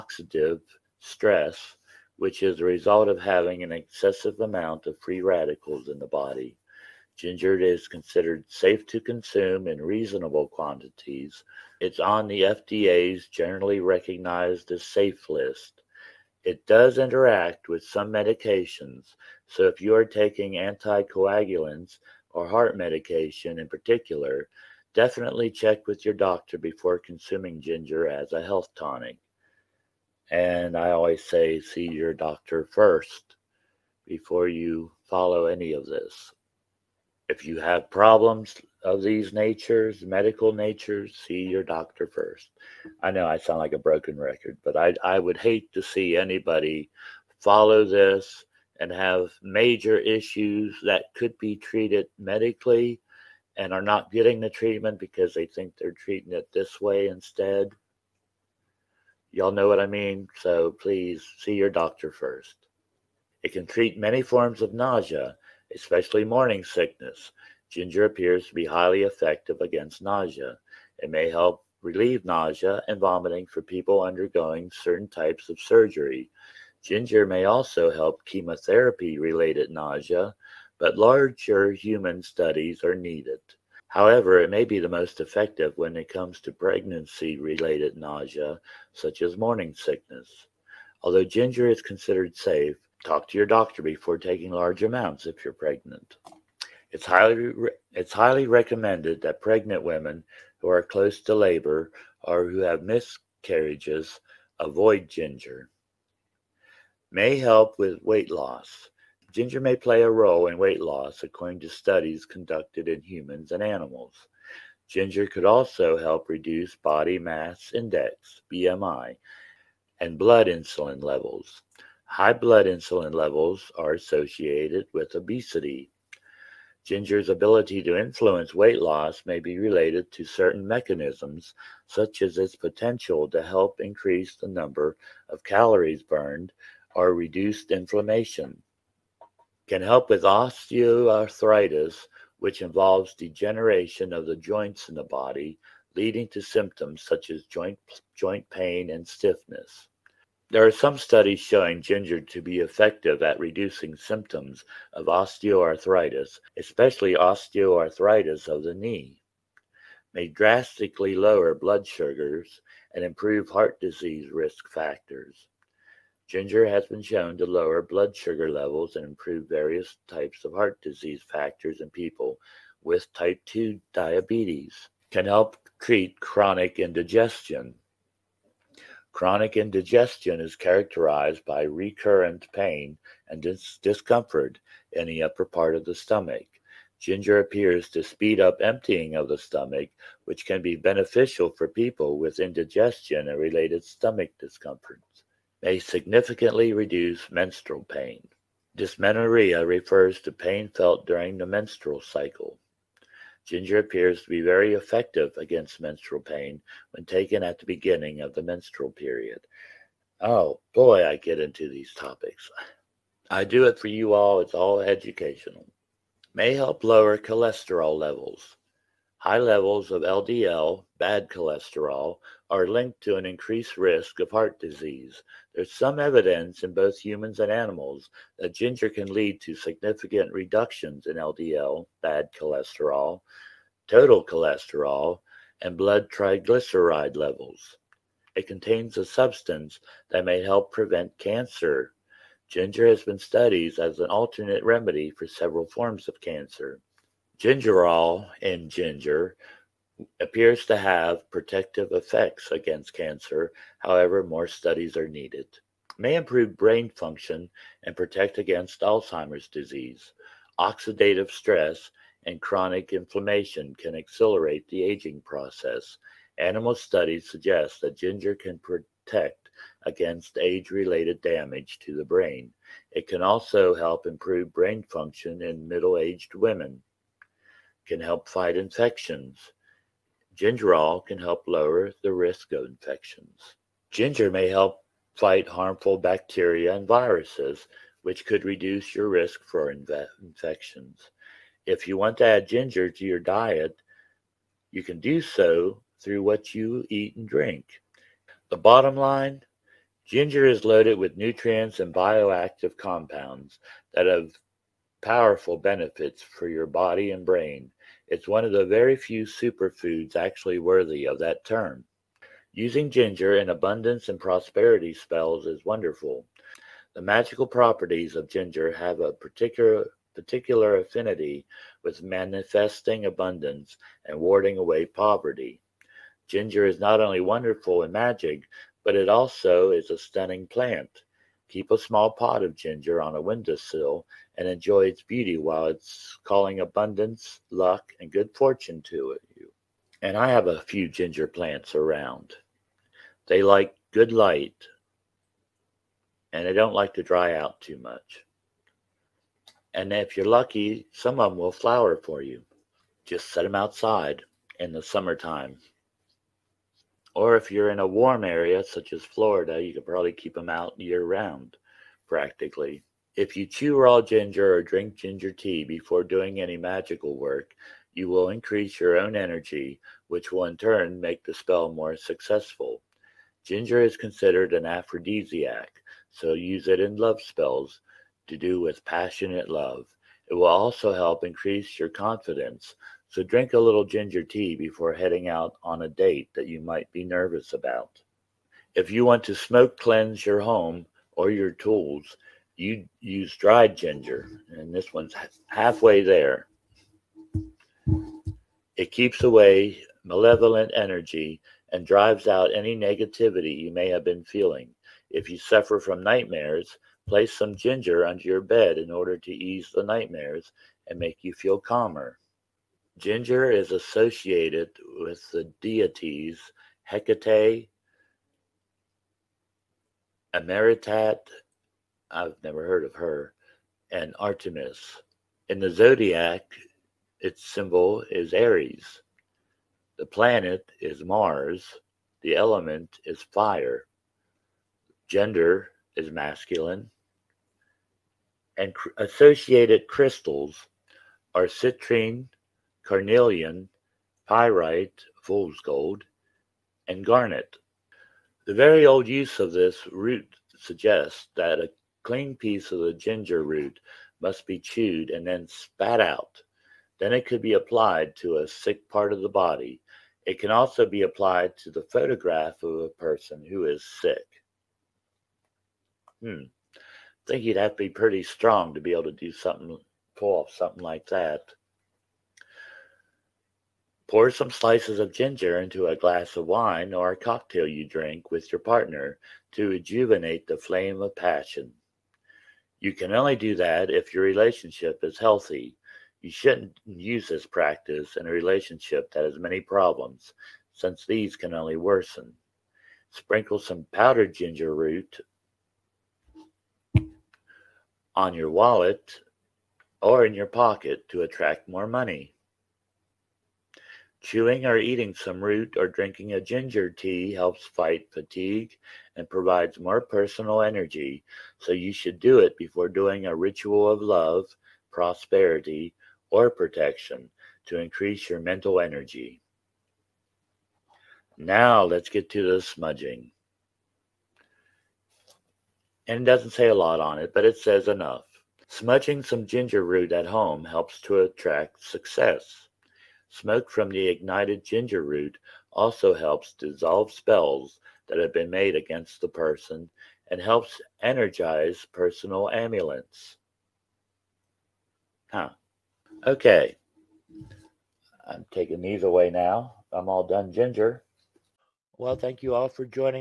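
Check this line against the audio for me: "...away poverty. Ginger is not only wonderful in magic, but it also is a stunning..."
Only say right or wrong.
right.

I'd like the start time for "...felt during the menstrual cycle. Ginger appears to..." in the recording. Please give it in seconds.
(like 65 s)
200 s.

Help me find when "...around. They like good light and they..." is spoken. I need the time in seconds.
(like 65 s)
341 s.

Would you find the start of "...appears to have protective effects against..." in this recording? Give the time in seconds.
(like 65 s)
250 s.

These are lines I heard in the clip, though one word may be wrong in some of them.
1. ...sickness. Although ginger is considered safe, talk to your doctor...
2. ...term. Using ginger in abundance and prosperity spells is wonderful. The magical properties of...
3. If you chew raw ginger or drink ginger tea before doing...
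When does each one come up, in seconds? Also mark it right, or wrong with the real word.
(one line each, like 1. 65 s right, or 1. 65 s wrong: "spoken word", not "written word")
1. 89 s right
2. 311 s right
3. 363 s right.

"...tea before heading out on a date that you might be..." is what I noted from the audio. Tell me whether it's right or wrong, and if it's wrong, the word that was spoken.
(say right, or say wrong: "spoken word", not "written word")
right.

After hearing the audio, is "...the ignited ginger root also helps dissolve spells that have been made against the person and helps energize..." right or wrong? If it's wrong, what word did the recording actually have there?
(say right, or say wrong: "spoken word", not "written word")
right.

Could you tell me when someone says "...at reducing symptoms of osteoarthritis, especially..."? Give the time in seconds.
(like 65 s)
153 s.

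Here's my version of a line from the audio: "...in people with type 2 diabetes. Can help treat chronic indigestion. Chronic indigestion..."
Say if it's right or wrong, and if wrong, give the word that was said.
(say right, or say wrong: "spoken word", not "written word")
right.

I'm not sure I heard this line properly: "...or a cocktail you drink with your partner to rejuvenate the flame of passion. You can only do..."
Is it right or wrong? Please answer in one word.
right.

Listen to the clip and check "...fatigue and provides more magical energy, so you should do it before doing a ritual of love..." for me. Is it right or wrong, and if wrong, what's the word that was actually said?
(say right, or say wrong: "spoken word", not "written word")
wrong: "personal", not "magical".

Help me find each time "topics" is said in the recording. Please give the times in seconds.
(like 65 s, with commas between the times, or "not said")
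211 s.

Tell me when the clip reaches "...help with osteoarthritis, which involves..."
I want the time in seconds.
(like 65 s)
139 s.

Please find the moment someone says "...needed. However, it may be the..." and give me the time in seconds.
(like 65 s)
82 s.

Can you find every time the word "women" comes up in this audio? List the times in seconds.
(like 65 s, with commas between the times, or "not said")
99 s, 276 s.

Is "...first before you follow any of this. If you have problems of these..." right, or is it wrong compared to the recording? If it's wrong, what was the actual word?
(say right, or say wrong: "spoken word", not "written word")
right.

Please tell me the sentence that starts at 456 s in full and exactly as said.
Then it could be applied to a sick part of the body.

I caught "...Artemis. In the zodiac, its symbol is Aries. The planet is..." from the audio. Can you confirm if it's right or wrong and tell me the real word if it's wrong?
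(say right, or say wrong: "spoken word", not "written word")
right.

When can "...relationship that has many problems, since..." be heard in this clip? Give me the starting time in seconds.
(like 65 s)
488 s.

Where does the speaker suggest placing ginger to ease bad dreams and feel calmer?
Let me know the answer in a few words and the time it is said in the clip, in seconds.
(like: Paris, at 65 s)
under your bed, at 408 s.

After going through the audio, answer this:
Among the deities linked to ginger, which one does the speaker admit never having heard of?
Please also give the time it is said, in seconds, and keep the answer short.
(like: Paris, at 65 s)
Ameretat, at 420 s.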